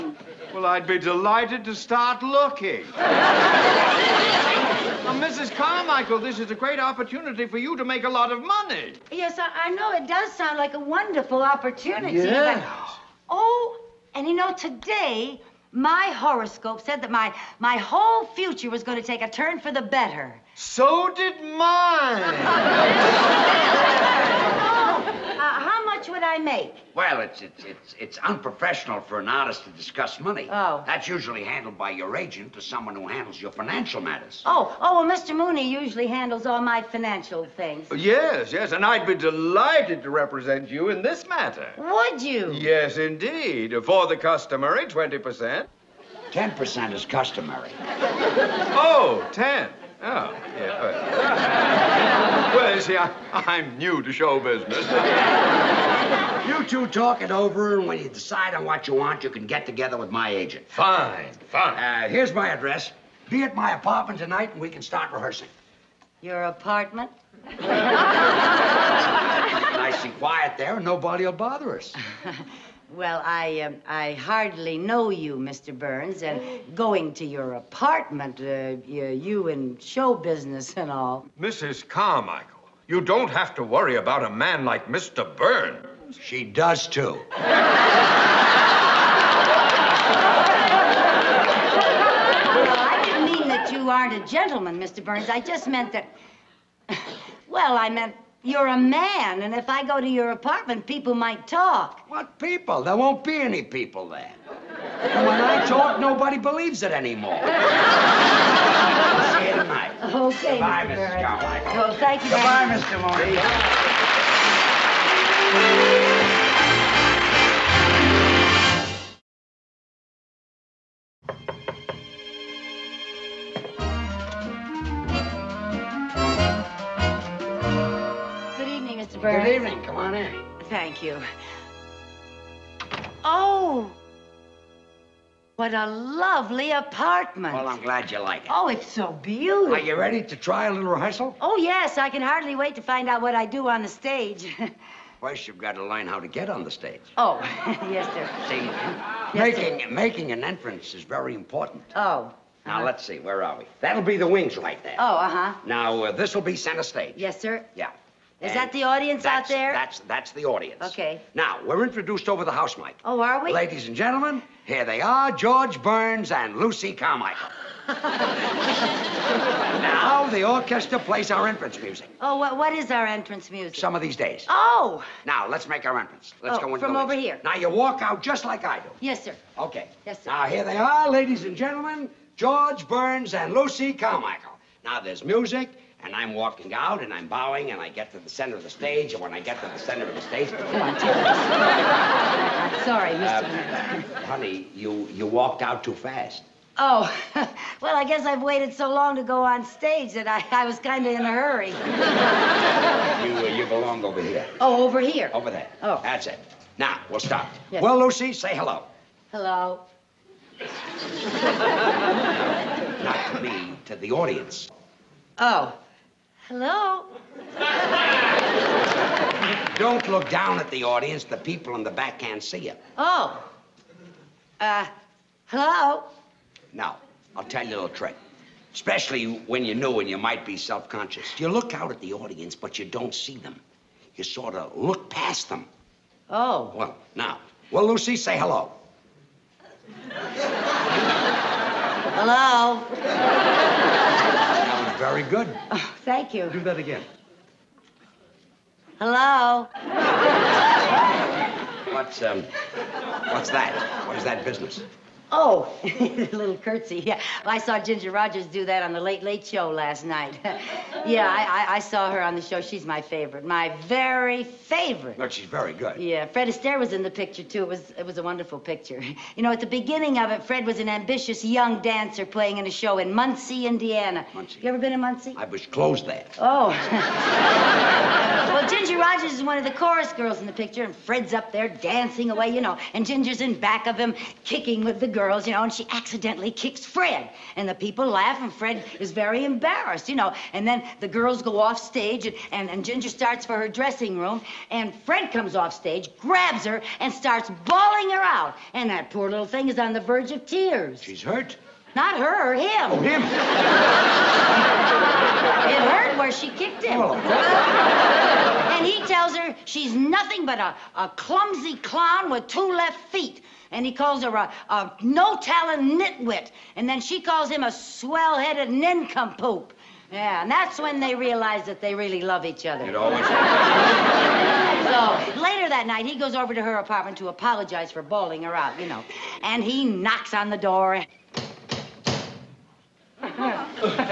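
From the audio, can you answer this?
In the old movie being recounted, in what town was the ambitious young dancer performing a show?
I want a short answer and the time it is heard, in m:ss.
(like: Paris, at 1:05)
Muncie, Indiana, at 4:33.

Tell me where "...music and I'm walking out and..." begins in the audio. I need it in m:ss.
3:05.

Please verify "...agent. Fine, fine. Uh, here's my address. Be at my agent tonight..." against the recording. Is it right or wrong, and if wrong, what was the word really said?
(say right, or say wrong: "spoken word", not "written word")
wrong: "apartment", not "agent".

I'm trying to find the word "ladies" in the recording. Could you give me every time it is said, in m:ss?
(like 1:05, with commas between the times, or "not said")
2:43, 3:01.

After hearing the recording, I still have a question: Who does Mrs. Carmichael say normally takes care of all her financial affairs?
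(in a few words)
Mr. Mooney.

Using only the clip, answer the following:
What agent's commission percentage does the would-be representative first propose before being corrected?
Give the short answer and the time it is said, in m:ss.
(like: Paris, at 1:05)
20%, at 0:44.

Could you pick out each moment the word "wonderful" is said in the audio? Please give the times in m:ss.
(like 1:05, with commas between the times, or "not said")
0:10, 4:28.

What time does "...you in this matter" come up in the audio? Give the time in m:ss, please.
0:40.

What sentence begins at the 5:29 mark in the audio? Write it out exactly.
And he knocks on the door.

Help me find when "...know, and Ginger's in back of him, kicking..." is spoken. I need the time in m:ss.
4:42.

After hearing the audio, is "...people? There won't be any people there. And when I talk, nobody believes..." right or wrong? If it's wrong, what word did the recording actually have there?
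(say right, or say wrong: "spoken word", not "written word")
right.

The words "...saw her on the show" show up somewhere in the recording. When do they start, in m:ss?
4:21.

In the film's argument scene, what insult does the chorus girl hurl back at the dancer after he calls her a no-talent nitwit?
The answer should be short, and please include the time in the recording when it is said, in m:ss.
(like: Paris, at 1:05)
swell headed nincompoop, at 5:17.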